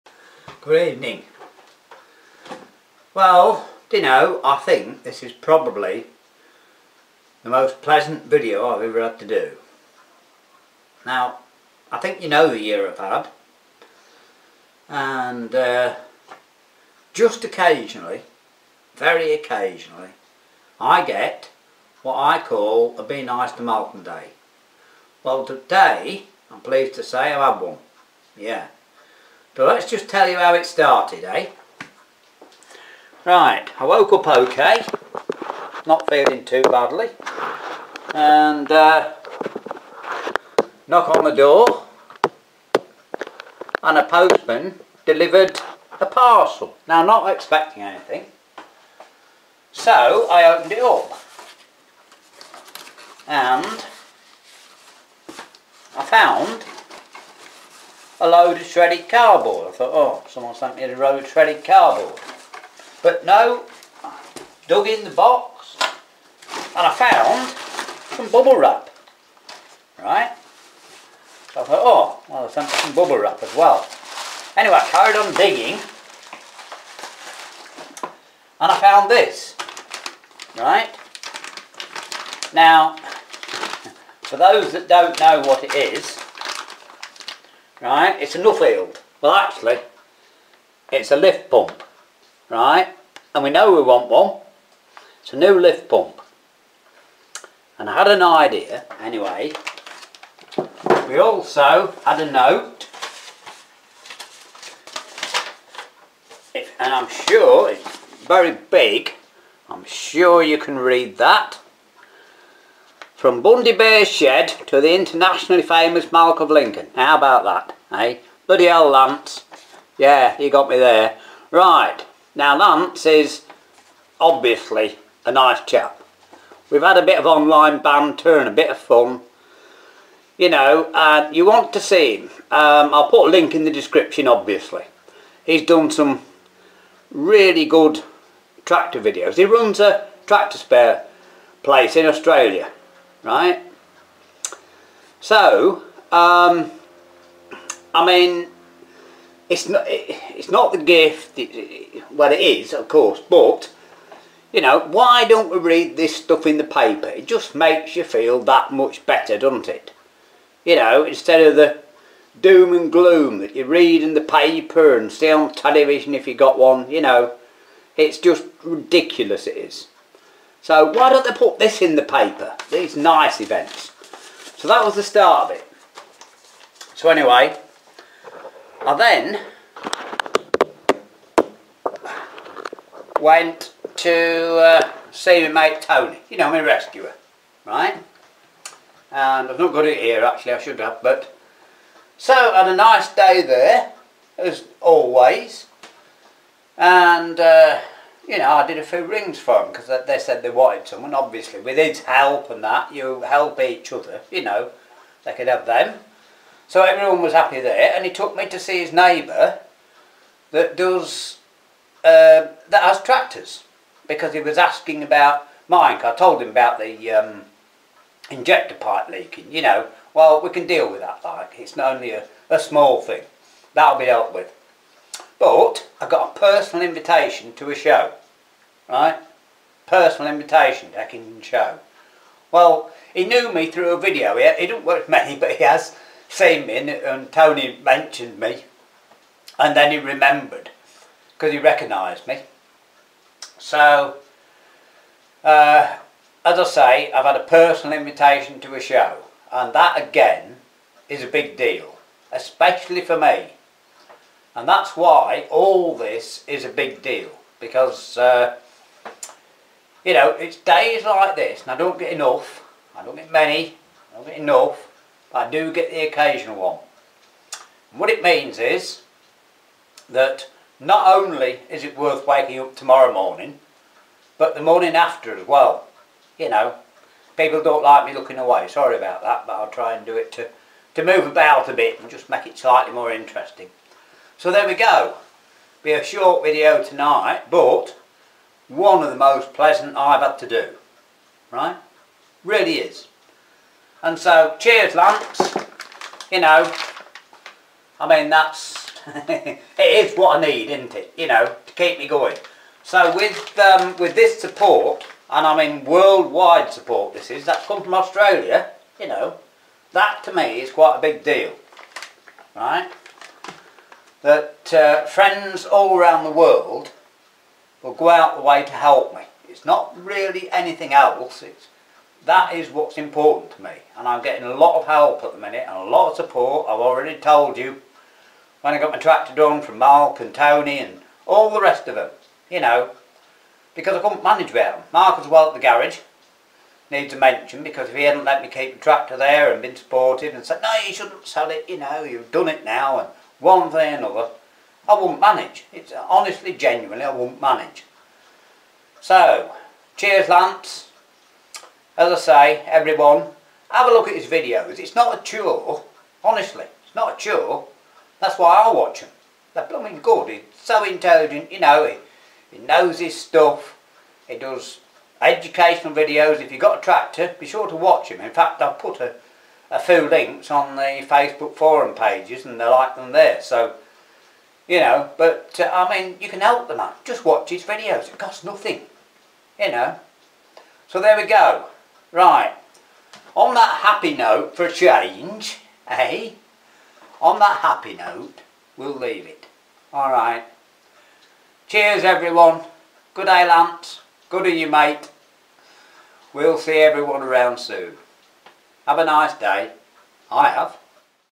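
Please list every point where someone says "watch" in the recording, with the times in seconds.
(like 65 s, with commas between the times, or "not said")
358 s, 367 s, 377 s.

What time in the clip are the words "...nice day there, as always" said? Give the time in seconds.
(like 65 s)
192 s.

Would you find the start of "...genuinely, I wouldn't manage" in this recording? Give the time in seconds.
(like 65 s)
346 s.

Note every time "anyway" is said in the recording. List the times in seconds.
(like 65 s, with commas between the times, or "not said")
74 s, 99 s, 177 s.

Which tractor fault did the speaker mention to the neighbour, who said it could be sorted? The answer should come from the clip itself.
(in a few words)
injector pipe leaking.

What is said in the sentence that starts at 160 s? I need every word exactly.
You know, instead of the doom and gloom that you read in the paper and see on television if you got one.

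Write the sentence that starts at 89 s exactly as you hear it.
Well, actually, it's a lift pump, right?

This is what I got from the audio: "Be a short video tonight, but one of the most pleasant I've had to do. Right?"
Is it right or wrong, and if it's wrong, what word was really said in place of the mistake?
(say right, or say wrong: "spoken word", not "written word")
right.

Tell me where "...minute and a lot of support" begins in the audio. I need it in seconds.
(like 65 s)
325 s.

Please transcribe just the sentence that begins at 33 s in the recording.
Right, I woke up okay, not feeling too badly, and uh, knock on the door, and a postman delivered a parcel.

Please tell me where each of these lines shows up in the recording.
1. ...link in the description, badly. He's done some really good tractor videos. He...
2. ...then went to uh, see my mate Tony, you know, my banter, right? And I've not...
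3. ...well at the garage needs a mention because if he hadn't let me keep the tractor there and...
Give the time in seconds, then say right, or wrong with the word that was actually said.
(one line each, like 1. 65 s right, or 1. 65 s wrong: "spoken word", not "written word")
1. 133 s wrong: "obviously", not "badly"
2. 178 s wrong: "rescuer", not "banter"
3. 335 s right.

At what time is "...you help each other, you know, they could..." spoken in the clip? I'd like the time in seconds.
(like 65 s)
202 s.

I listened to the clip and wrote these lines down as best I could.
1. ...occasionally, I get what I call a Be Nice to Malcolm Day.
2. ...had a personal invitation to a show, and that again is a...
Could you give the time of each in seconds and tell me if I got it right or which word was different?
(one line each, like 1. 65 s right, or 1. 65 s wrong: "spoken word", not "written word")
1. 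19 s right
2. 247 s right.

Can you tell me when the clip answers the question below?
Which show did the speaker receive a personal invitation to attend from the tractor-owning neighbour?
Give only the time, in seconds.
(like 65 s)
230 s.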